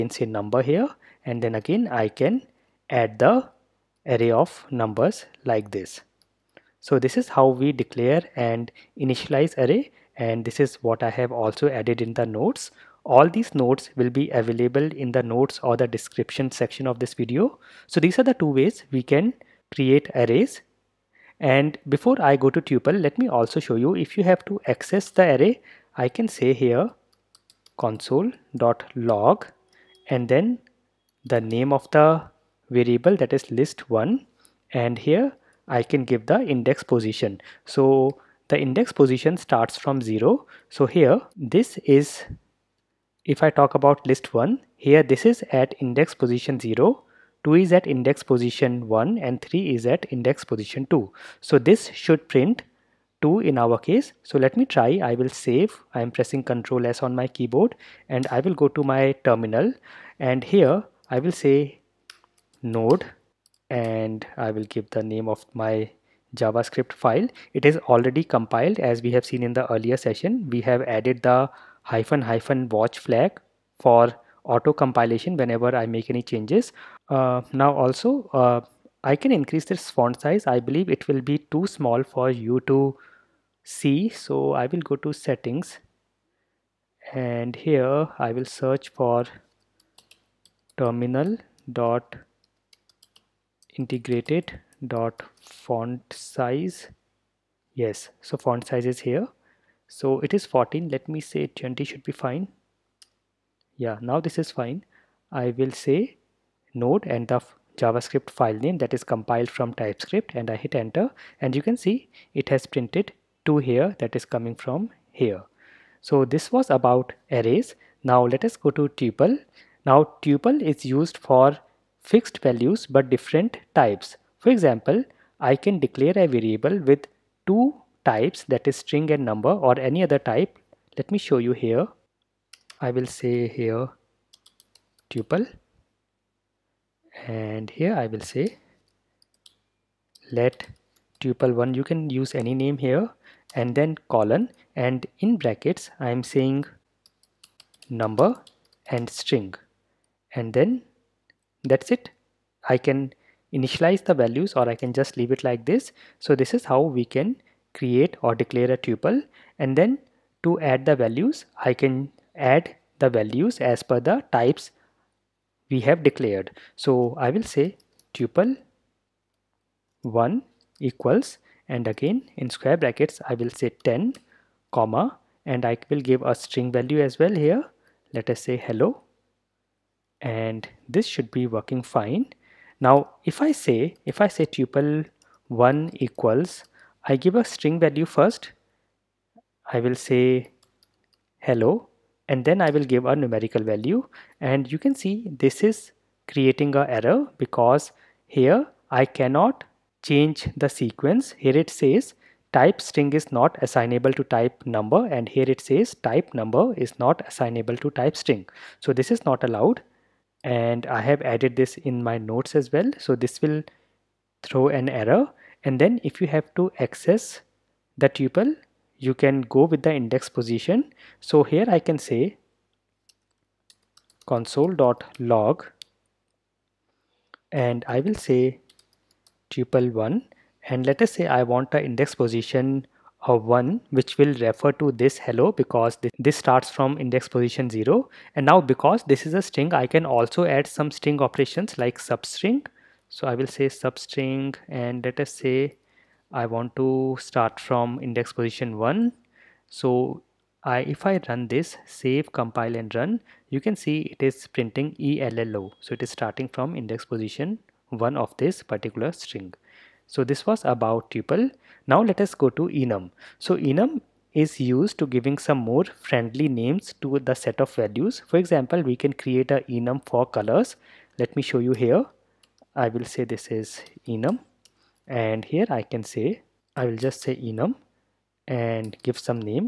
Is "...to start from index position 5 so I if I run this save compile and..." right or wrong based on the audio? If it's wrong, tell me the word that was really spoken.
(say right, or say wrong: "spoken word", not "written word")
wrong: "1", not "5".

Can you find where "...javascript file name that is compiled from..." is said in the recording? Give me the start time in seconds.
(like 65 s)
107 s.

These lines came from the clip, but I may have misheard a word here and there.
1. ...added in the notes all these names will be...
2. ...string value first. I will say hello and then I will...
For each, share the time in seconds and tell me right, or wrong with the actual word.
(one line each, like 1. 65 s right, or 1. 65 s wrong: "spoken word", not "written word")
1. 11 s wrong: "notes", not "names"
2. 187 s right.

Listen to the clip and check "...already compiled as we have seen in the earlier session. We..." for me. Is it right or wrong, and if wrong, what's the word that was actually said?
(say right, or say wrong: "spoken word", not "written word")
right.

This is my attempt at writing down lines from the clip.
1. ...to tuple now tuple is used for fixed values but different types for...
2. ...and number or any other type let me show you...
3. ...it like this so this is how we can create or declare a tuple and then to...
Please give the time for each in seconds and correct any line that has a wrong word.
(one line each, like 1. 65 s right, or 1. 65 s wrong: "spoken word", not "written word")
1. 118 s right
2. 129 s right
3. 155 s right.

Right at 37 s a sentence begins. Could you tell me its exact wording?
So the index position starts from 0.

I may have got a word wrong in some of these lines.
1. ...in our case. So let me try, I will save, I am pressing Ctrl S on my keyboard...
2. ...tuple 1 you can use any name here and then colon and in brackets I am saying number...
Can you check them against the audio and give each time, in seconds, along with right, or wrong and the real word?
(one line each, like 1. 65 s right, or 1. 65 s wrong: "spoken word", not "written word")
1. 53 s right
2. 141 s right.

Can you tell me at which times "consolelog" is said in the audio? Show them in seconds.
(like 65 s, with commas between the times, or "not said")
27 s, 224 s.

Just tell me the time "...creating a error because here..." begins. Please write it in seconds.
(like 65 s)
196 s.